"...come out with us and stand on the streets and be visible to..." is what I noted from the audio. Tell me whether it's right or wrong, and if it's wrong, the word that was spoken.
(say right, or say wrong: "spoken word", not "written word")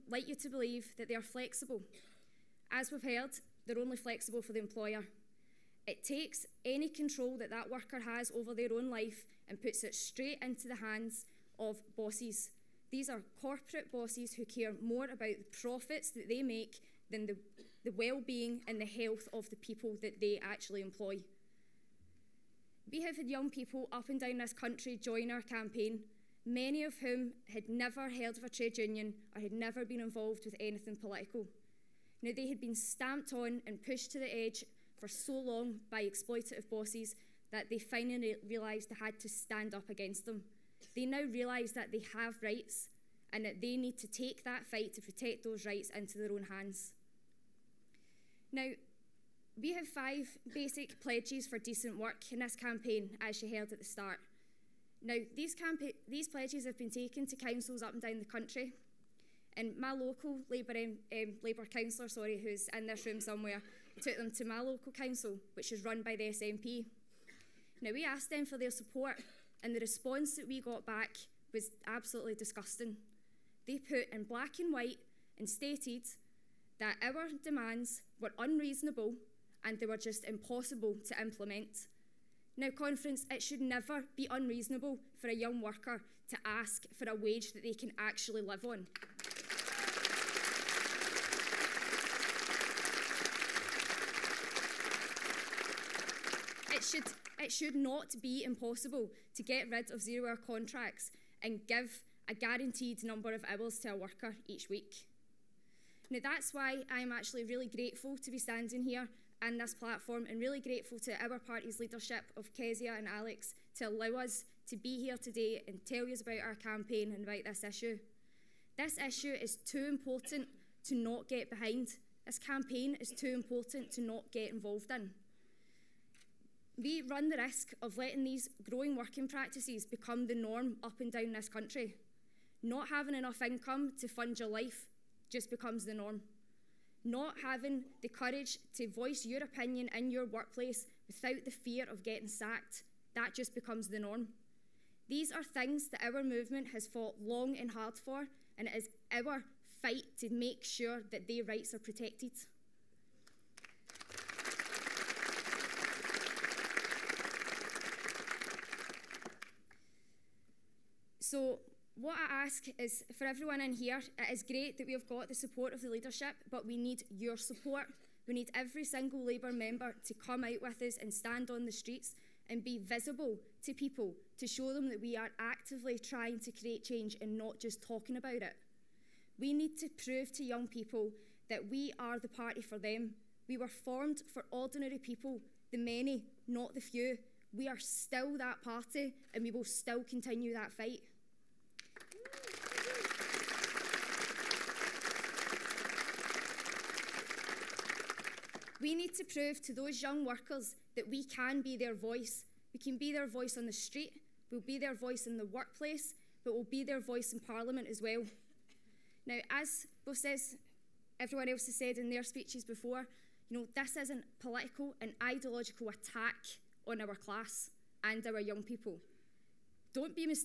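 right.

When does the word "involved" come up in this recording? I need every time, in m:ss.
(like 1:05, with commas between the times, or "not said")
0:30, 2:04.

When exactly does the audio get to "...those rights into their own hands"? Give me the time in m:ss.
0:45.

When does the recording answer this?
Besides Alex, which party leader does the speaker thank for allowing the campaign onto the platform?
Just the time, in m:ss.
1:52.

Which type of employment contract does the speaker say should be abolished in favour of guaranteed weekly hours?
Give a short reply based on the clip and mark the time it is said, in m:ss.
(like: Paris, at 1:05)
Zero hour contracts, at 1:40.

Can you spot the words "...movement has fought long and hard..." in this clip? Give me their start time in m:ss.
2:26.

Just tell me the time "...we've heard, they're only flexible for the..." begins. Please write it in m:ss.
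0:02.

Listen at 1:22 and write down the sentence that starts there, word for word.
Now, conference, it should never be unreasonable for a young worker to ask for a wage that they can actually live on.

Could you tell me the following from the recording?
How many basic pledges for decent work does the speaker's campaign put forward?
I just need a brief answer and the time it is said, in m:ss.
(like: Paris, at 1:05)
5, at 0:49.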